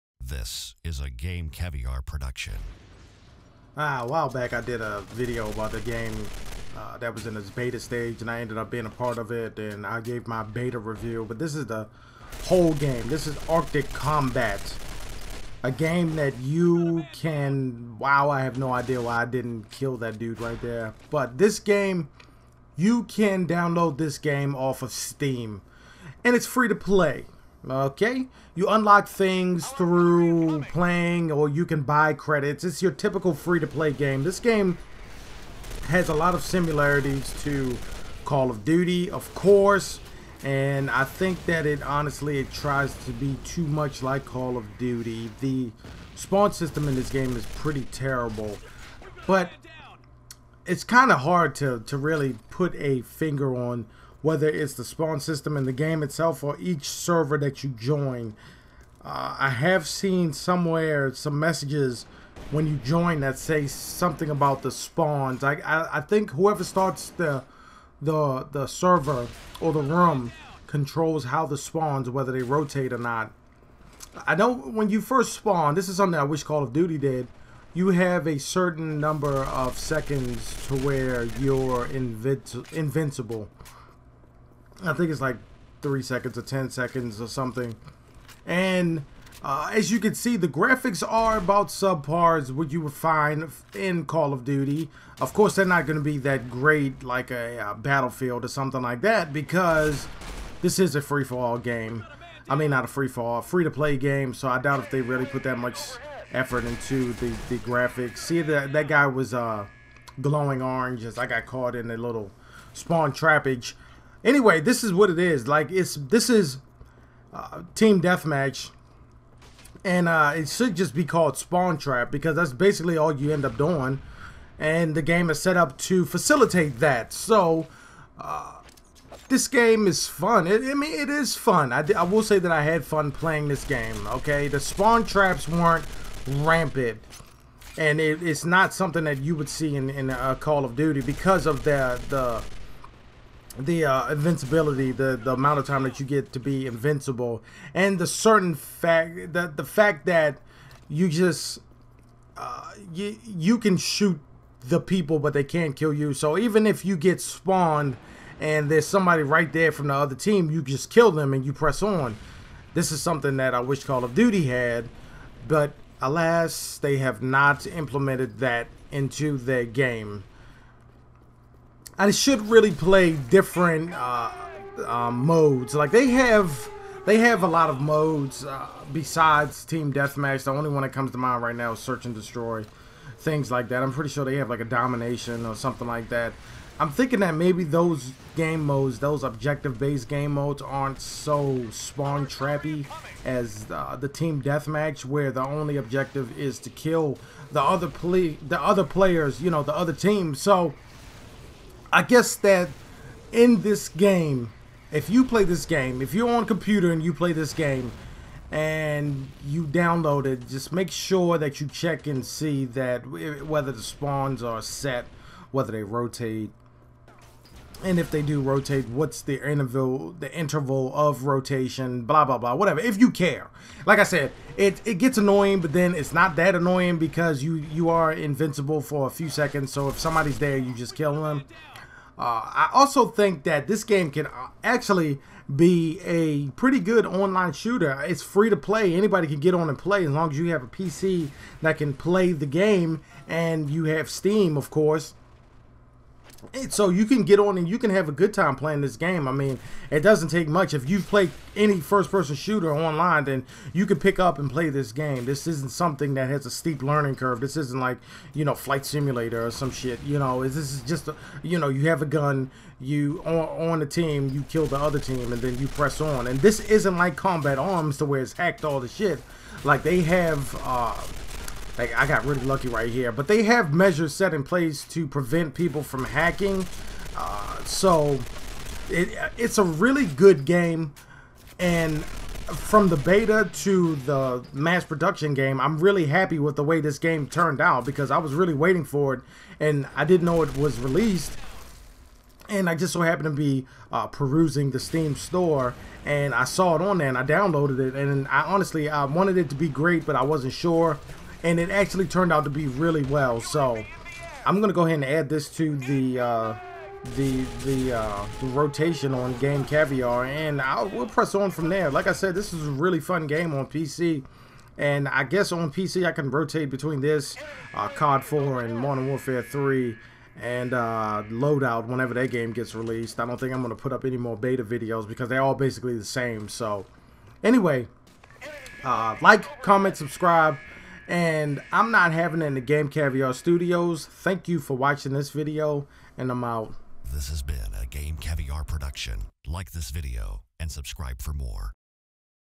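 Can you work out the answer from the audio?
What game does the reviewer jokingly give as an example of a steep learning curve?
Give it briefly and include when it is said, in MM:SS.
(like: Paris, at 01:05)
Flight Simulator, at 04:18.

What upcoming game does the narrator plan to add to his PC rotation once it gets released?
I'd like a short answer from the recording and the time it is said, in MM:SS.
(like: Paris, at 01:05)
Loadout, at 05:21.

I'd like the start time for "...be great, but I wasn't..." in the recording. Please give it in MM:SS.
04:59.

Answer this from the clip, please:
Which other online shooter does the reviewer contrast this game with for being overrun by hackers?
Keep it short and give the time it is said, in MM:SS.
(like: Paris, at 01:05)
Combat Arms, at 04:27.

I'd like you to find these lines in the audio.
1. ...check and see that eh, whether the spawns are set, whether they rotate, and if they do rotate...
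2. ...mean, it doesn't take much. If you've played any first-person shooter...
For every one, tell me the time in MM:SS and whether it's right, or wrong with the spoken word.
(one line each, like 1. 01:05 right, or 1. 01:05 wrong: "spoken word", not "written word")
1. 03:31 right
2. 04:09 right.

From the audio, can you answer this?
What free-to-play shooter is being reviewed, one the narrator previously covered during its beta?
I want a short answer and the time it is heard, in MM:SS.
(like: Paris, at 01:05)
Arctic Combat, at 00:13.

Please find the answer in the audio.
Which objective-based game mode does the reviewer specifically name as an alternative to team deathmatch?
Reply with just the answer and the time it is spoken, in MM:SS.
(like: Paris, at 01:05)
Search and Destroy, at 03:01.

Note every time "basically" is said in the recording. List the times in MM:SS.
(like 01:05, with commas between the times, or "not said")
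02:02, 05:25.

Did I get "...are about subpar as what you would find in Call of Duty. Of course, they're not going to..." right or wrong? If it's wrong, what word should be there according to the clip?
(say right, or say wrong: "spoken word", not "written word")
right.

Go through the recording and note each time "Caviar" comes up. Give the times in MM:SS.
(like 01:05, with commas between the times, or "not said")
00:01, 05:09, 05:32, 05:38.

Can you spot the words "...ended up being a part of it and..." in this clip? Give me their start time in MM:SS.
00:08.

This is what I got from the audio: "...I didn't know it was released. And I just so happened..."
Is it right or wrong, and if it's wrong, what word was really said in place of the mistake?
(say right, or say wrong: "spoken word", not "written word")
right.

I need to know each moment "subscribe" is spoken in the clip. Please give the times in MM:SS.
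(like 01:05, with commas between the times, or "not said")
05:29, 05:40.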